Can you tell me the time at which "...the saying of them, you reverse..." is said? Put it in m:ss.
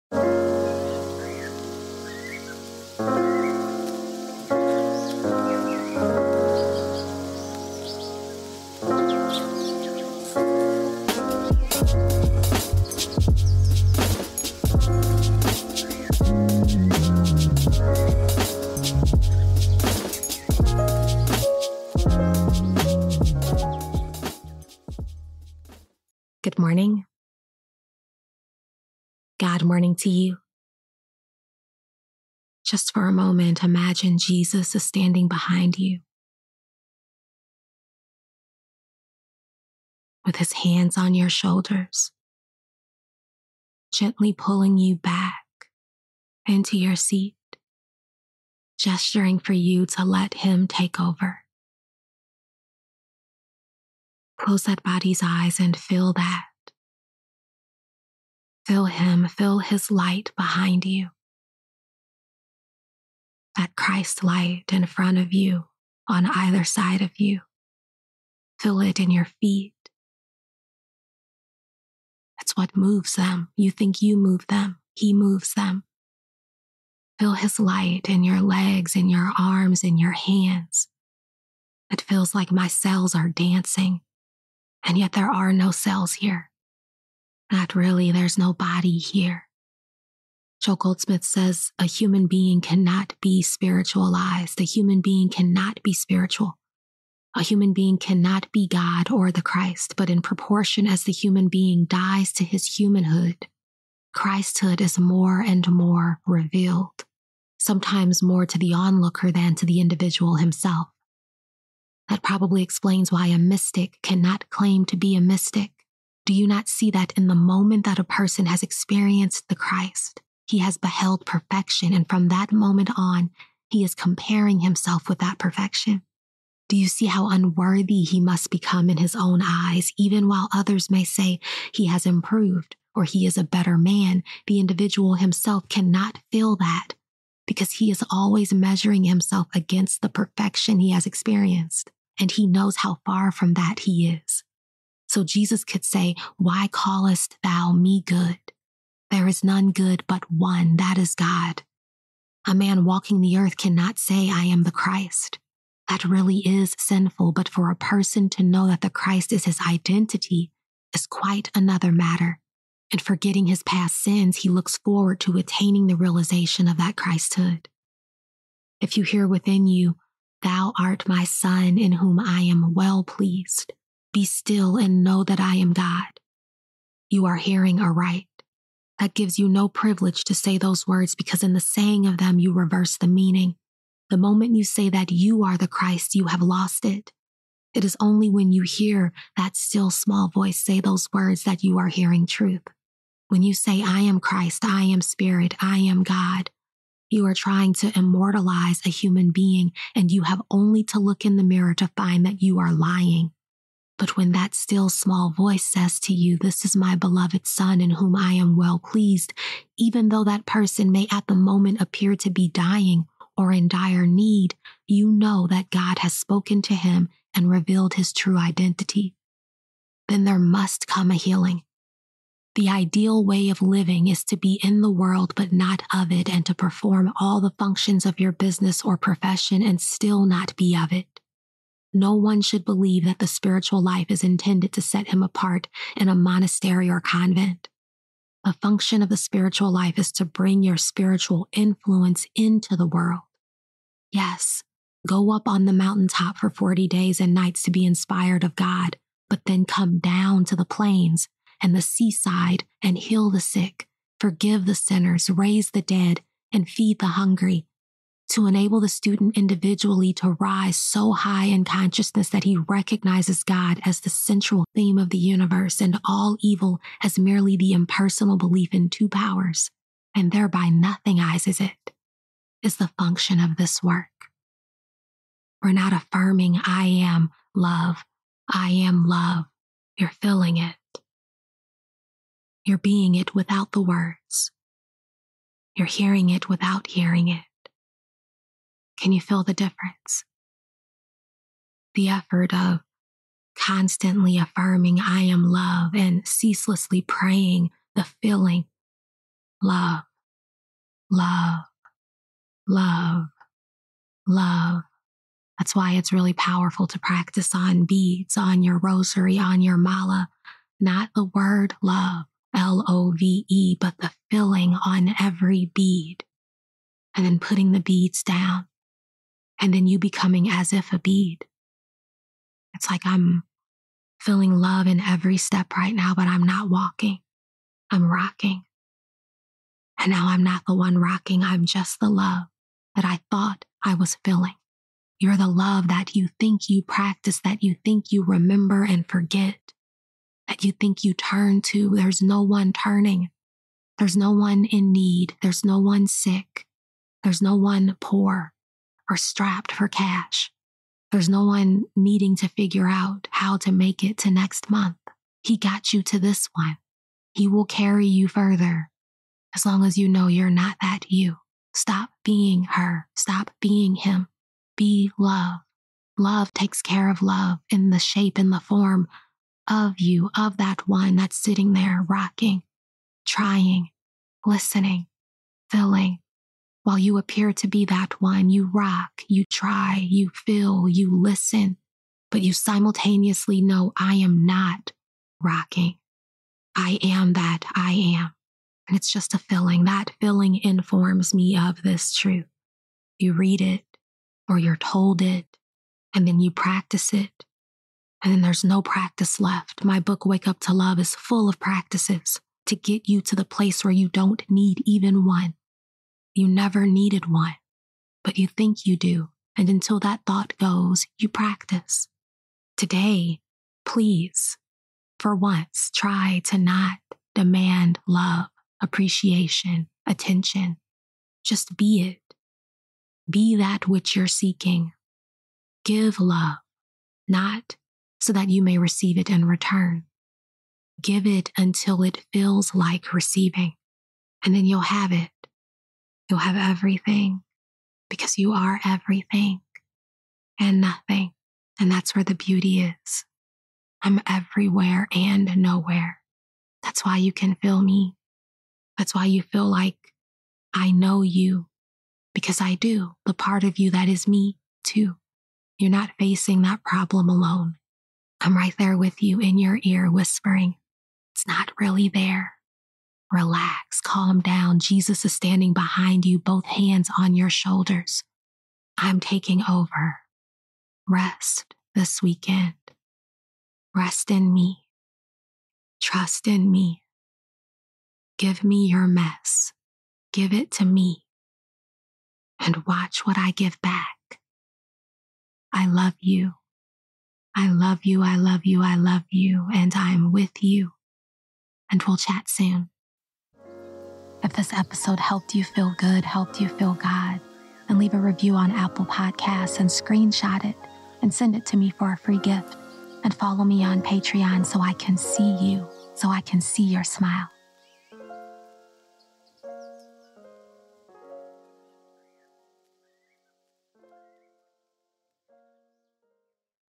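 3:01.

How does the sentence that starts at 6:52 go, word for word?
Today, please, for once, try to not demand love, appreciation, attention.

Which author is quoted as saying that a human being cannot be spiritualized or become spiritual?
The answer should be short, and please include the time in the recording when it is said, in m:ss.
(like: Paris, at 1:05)
Joel Goldsmith, at 1:30.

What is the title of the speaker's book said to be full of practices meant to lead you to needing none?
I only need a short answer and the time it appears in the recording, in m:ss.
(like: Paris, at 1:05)
Wake Up to Love, at 6:40.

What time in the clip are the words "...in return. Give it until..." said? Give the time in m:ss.
7:09.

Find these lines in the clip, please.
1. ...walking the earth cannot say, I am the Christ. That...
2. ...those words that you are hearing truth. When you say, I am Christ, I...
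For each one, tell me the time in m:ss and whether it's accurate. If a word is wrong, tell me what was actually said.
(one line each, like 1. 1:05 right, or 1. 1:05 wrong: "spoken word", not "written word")
1. 2:32 right
2. 3:10 right.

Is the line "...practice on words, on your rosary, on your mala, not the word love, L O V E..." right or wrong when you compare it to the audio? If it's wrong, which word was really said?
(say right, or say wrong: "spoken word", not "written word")
wrong: "beads", not "words".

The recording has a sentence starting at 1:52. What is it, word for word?
That probably explains why a mystic cannot claim to be a mystic.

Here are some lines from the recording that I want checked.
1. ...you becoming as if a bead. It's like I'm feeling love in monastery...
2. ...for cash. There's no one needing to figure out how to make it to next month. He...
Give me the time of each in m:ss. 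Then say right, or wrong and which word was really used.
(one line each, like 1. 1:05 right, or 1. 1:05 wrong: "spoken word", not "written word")
1. 5:19 wrong: "every", not "monastery"
2. 5:49 right.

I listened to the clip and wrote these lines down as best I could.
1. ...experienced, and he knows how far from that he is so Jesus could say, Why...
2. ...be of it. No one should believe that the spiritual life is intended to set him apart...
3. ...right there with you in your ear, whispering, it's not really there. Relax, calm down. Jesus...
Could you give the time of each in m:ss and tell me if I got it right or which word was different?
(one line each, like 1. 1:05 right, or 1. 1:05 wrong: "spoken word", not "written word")
1. 2:21 right
2. 3:50 right
3. 7:38 right.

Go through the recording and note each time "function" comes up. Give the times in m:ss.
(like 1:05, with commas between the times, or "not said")
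3:47, 3:58, 4:32.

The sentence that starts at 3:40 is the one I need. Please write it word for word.
Then there must come a healing.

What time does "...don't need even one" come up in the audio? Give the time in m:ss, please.
6:44.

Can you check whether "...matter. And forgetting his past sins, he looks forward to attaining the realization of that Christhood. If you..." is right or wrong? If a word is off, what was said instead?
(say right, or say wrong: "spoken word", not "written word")
right.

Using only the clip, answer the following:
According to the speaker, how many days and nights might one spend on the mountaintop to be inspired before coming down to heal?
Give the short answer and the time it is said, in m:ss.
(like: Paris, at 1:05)
40, at 4:06.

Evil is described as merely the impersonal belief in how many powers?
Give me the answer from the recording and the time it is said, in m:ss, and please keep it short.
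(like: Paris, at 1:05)
2, at 4:28.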